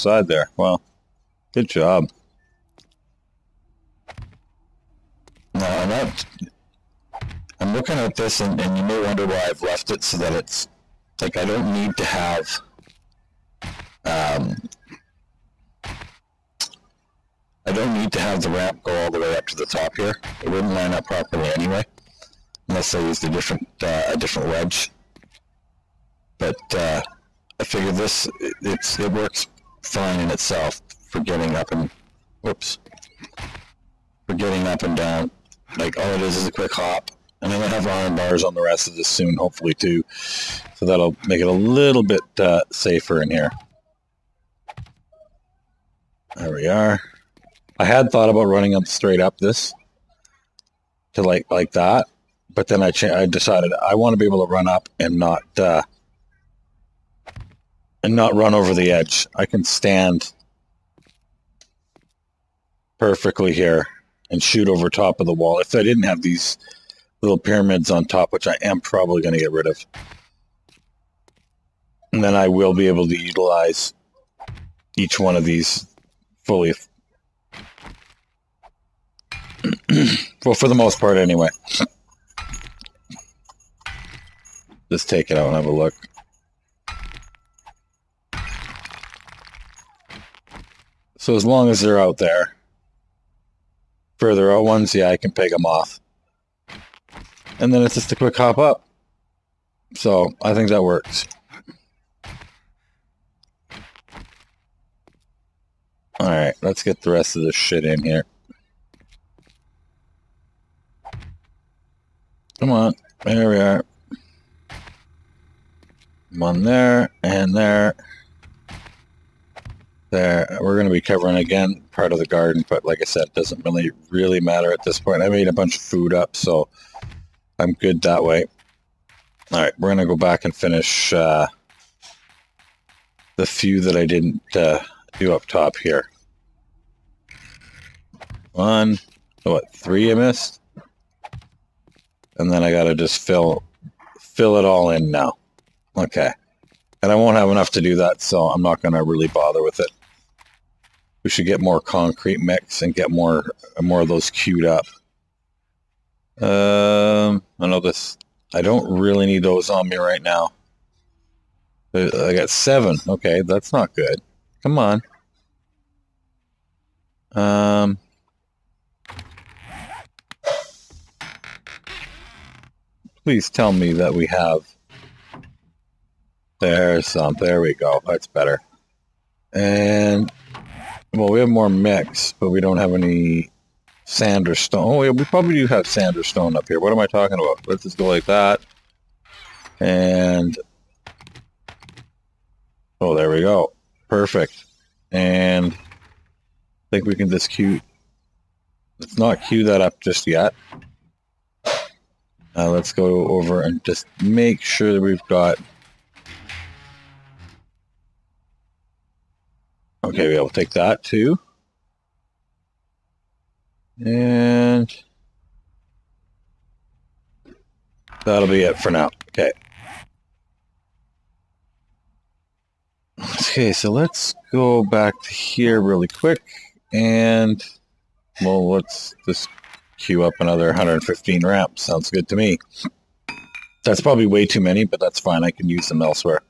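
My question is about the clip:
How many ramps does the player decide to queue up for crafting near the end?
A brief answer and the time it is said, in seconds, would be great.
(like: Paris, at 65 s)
115, at 230 s.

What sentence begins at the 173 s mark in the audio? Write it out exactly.
Please tell me that we have there's some.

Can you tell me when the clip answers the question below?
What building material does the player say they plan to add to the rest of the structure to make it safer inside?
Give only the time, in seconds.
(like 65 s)
37 s.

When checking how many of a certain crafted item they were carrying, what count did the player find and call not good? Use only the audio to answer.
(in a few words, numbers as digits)
7.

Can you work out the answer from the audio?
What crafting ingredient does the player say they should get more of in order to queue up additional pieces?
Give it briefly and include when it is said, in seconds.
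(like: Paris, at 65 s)
concrete mix, at 151 s.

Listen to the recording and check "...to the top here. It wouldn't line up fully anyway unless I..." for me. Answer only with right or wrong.
wrong.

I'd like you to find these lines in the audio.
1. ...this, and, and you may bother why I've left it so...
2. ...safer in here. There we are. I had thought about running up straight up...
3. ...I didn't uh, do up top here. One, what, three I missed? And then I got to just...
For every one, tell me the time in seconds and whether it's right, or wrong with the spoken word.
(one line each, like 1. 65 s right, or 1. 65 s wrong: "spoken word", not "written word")
1. 8 s wrong: "wonder", not "bother"
2. 42 s right
3. 133 s right.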